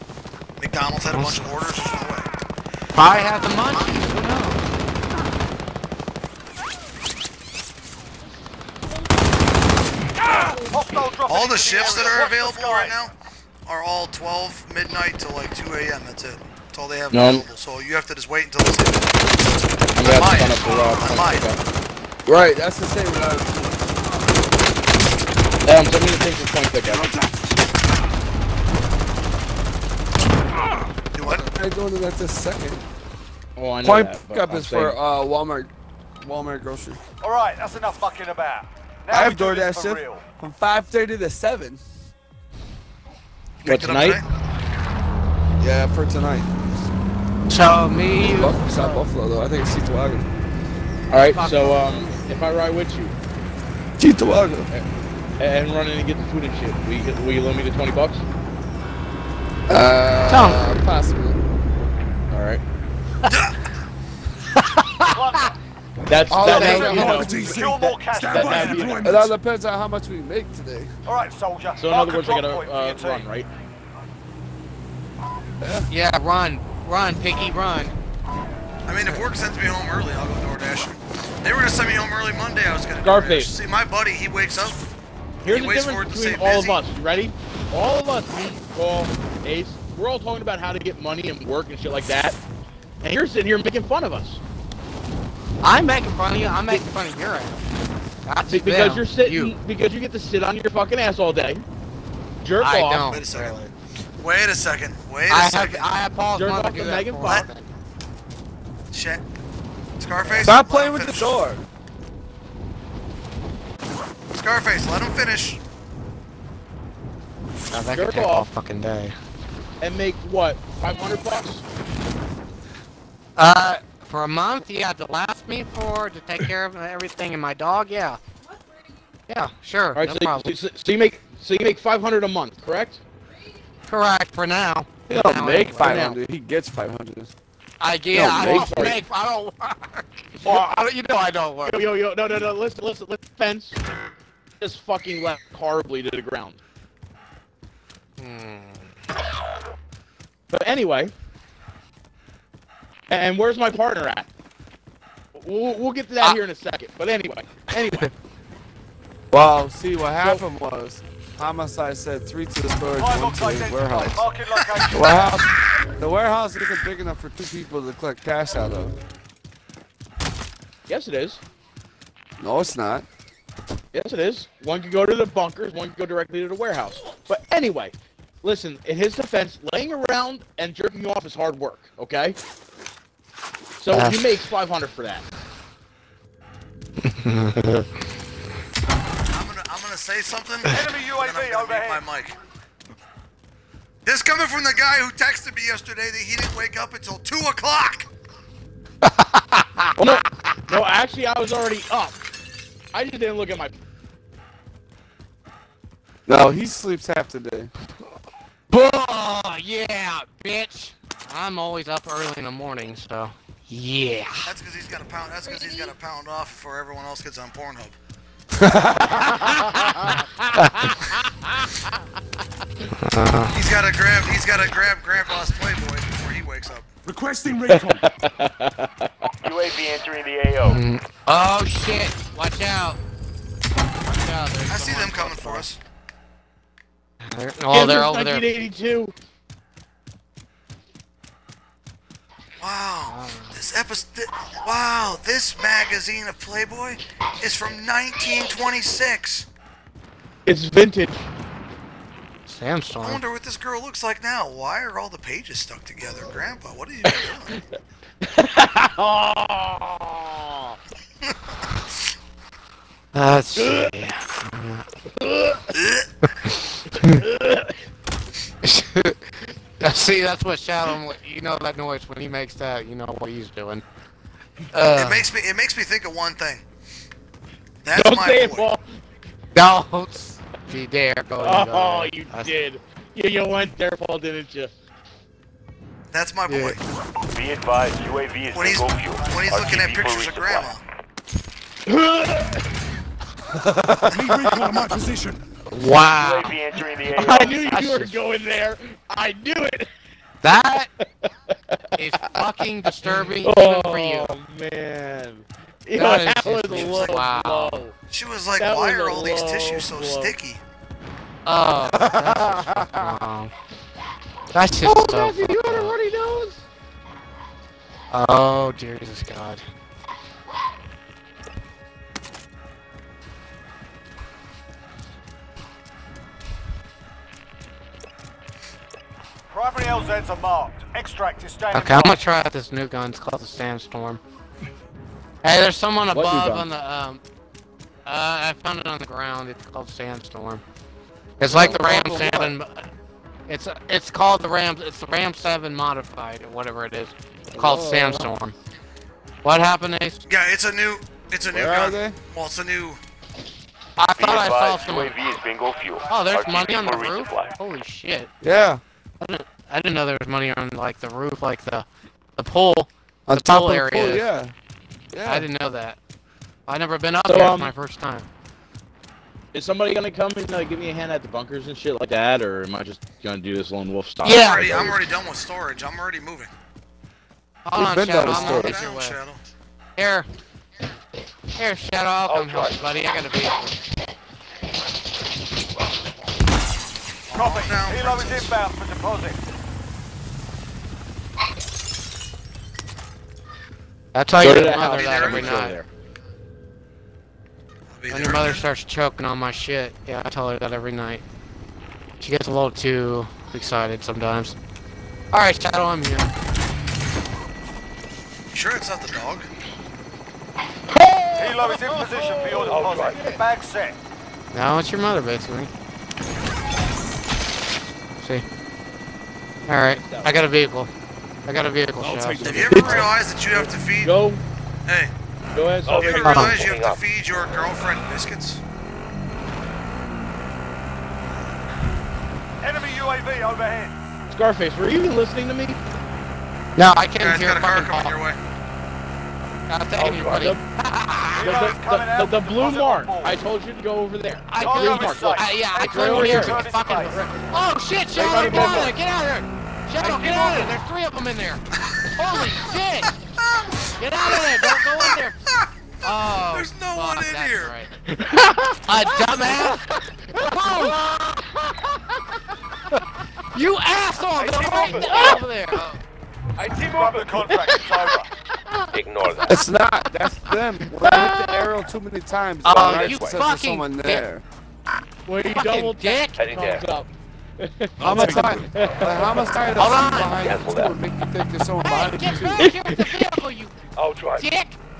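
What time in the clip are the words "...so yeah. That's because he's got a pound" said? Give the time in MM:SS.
03:32.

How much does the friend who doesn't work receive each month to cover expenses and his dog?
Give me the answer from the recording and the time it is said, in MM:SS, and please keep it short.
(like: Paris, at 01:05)
$500, at 02:00.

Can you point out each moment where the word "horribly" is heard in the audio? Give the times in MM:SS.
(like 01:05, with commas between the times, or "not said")
02:25.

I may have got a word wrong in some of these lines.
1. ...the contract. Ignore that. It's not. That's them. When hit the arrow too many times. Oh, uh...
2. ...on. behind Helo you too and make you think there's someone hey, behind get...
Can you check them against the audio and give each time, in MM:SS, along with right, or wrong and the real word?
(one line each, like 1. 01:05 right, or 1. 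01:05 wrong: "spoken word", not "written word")
1. 07:47 right
2. 07:59 wrong: "Cancel", not "Helo".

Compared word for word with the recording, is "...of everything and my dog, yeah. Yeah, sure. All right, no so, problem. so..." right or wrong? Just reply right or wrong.
right.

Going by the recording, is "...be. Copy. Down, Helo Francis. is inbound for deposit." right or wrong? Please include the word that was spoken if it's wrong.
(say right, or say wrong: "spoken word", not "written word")
right.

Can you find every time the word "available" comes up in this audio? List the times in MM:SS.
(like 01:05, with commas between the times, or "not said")
00:12, 00:17.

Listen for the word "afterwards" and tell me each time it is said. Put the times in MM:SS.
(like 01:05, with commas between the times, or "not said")
not said.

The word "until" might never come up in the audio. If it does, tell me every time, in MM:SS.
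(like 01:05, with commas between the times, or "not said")
00:18, 03:16.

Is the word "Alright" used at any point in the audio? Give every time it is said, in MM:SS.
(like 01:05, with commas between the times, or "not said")
00:51, 01:02, 06:45, 06:59.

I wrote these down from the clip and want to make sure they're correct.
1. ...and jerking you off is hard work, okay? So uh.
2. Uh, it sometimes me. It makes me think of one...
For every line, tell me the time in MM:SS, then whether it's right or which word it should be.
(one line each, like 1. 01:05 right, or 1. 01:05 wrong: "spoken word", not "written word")
1. 03:00 right
2. 04:34 wrong: "makes", not "sometimes".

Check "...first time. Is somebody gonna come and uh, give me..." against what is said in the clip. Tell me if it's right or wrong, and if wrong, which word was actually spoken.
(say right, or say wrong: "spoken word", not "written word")
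right.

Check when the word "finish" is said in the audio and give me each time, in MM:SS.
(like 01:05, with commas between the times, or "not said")
01:51, 01:55.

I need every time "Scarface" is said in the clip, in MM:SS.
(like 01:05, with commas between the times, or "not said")
01:23, 01:50, 01:54, 07:14.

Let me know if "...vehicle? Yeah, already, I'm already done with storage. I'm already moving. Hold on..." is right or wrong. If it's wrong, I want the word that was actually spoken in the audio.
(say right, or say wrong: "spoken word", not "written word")
wrong: "style", not "vehicle".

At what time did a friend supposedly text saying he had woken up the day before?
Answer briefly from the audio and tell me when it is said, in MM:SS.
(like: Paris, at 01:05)
2 o'clock, at 03:17.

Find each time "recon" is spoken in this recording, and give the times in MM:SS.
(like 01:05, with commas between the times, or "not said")
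03:47, 04:54.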